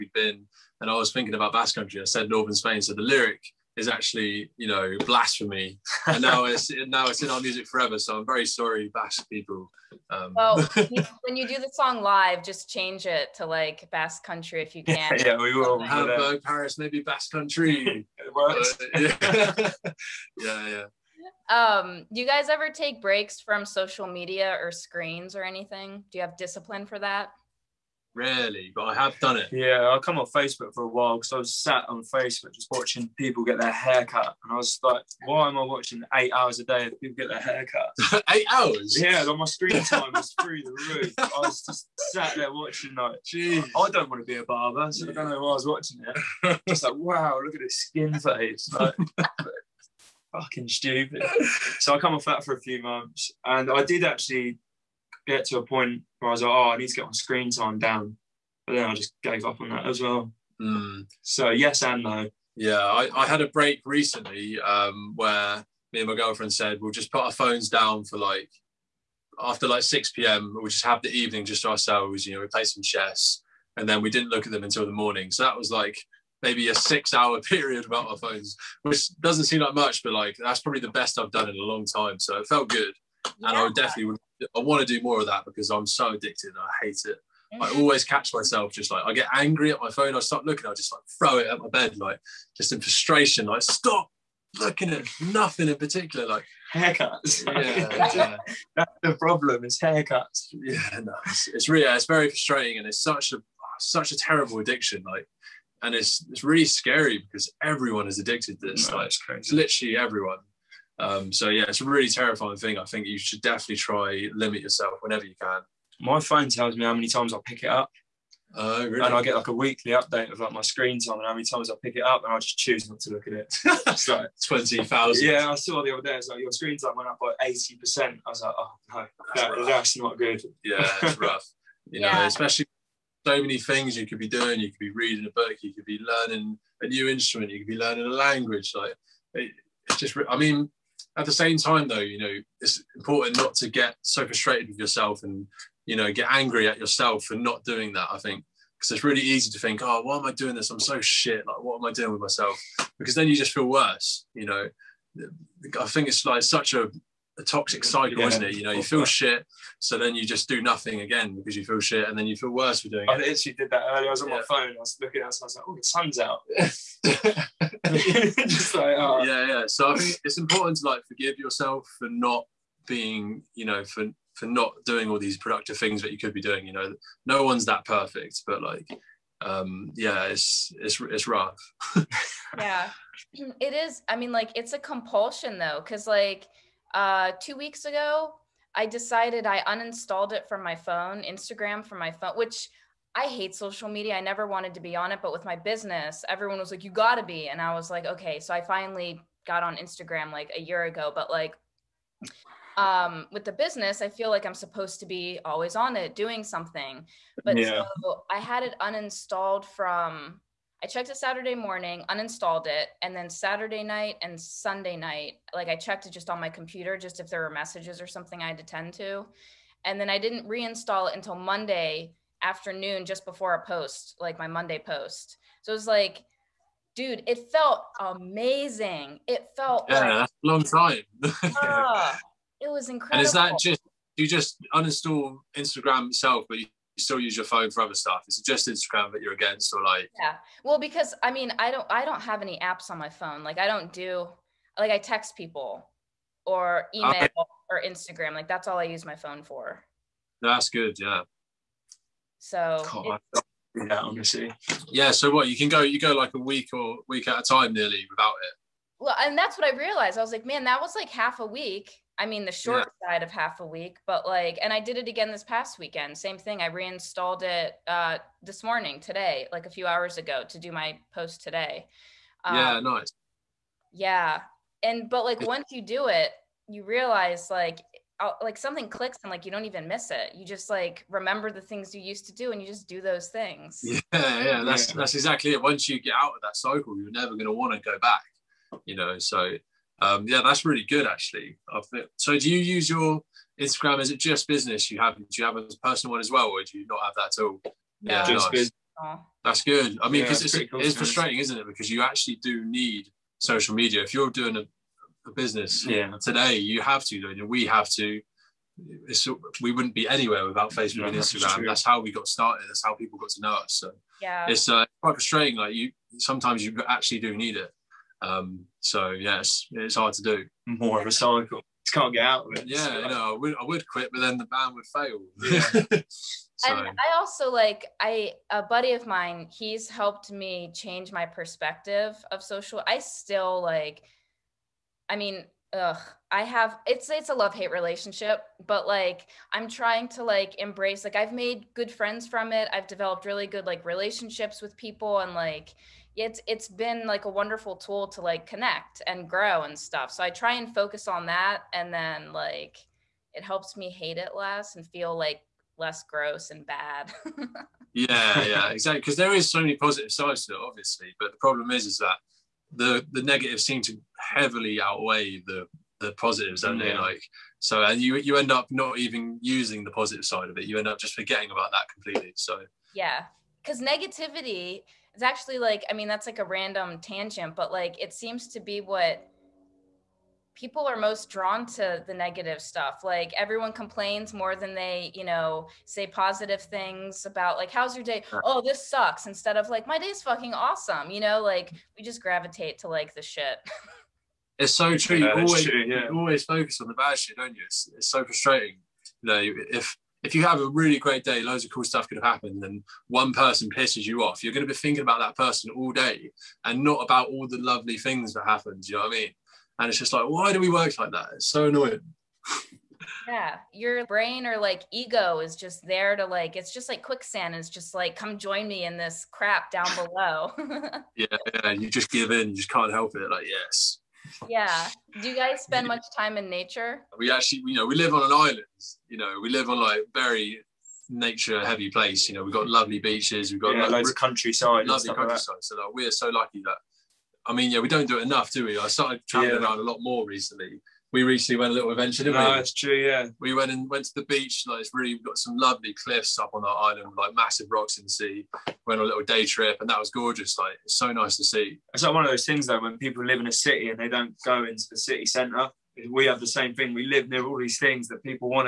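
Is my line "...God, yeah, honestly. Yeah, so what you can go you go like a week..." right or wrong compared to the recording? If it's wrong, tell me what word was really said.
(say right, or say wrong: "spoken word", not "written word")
right.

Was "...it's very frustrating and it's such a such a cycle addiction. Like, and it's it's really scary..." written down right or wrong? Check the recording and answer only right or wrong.
wrong.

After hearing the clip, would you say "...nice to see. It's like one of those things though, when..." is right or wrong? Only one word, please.
right.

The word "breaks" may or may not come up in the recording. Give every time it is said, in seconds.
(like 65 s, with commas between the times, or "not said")
23 s, 63 s.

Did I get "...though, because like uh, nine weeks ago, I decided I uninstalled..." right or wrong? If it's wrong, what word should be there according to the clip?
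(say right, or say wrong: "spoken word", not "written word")
wrong: "two", not "nine".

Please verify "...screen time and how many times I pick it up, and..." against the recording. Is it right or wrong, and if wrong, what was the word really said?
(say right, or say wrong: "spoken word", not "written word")
right.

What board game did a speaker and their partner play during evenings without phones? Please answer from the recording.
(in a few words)
Chess.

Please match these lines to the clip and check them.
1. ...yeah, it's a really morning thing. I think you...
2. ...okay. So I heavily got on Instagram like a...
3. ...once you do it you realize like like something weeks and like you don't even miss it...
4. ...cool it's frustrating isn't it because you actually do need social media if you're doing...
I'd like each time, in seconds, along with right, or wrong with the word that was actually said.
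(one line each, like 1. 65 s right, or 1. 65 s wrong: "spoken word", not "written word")
1. 111 s wrong: "terrifying", not "morning"
2. 198 s wrong: "finally", not "heavily"
3. 275 s wrong: "clicks", not "weeks"
4. 300 s right.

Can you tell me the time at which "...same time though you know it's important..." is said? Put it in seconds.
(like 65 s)
141 s.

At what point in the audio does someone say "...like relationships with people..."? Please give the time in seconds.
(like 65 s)
343 s.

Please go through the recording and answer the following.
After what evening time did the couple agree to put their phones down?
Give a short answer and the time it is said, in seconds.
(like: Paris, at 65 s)
6 p.m., at 69 s.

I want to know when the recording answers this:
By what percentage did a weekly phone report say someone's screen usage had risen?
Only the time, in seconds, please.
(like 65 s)
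127 s.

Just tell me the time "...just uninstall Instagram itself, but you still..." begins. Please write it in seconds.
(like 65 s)
234 s.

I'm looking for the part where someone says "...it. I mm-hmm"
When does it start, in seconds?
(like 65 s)
87 s.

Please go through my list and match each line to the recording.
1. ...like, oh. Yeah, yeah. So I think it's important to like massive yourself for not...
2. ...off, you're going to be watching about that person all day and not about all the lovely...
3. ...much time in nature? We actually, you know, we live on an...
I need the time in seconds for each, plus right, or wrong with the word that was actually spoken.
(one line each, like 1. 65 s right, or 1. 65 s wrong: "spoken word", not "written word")
1. 168 s wrong: "forgive", not "massive"
2. 404 s wrong: "thinking", not "watching"
3. 425 s right.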